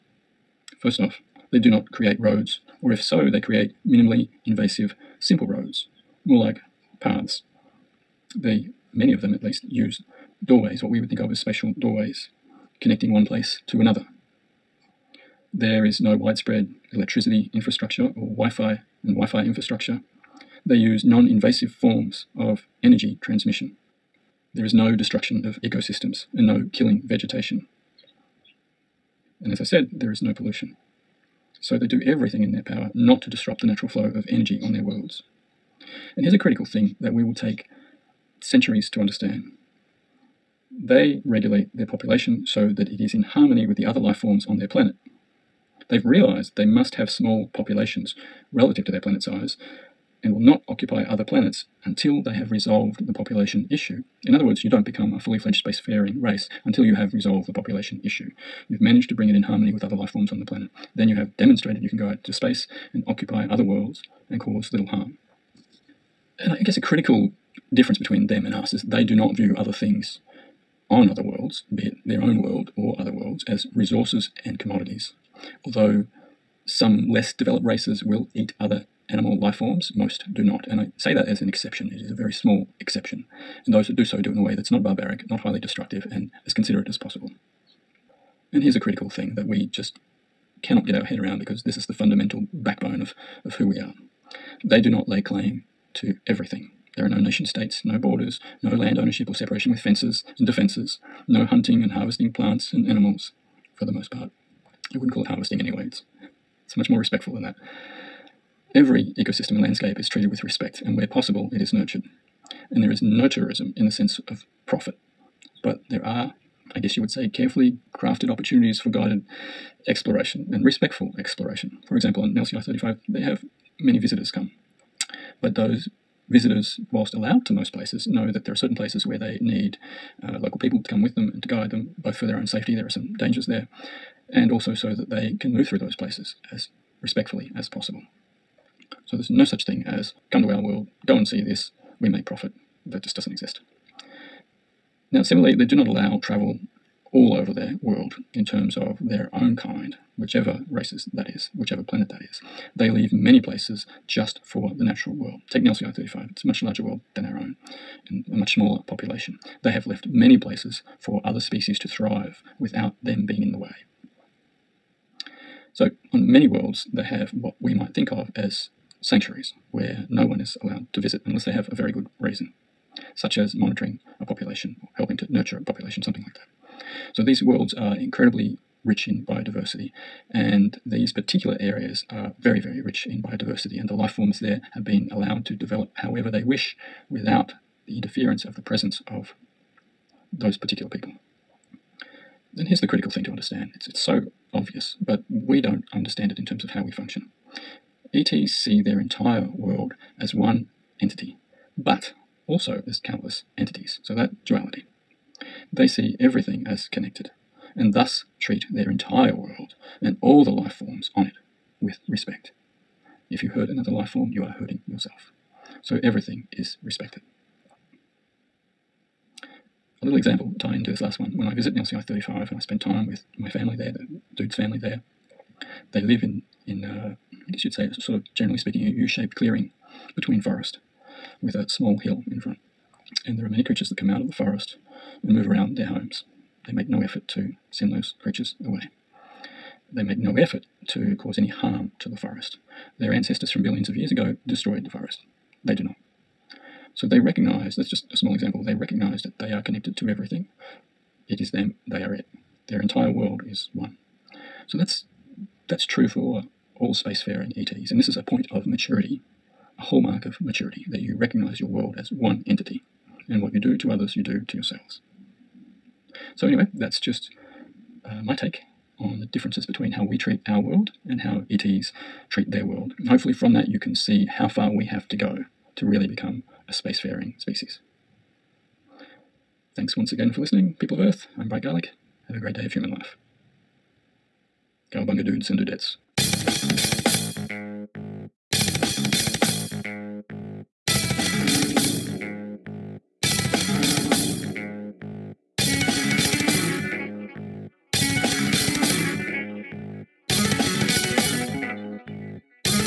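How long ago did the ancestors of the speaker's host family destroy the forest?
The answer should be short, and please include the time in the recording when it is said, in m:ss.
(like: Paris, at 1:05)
Billions of years ago, at 4:03.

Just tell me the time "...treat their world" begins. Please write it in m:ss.
4:32.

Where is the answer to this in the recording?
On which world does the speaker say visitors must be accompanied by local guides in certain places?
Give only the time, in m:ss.
2:02.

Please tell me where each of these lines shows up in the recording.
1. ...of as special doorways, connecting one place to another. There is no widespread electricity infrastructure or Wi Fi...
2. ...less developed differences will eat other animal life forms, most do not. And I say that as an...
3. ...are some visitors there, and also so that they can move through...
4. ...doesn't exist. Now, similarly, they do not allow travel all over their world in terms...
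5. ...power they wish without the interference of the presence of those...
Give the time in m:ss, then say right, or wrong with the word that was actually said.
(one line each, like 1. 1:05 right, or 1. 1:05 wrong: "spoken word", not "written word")
1. 0:11 right
2. 1:17 wrong: "races", not "differences"
3. 2:12 wrong: "dangers", not "visitors"
4. 2:23 right
5. 3:06 wrong: "however", not "power".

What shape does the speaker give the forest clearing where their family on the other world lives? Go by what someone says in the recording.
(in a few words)
U shaped.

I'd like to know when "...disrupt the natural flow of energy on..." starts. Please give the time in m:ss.
0:33.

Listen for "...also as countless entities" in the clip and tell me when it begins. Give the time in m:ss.
3:22.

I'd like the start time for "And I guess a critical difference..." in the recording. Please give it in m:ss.
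1:06.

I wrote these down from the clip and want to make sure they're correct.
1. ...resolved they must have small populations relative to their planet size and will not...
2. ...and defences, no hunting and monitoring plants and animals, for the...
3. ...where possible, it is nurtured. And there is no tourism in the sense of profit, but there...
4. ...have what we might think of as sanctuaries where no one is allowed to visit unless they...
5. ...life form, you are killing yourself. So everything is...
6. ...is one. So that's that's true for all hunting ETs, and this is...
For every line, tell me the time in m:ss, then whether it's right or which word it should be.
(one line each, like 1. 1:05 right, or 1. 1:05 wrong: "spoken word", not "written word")
1. 0:46 wrong: "realized", not "resolved"
2. 1:40 wrong: "harvesting", not "monitoring"
3. 1:50 right
4. 2:47 right
5. 3:33 wrong: "hurting", not "killing"
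6. 4:13 wrong: "spacefaring", not "hunting".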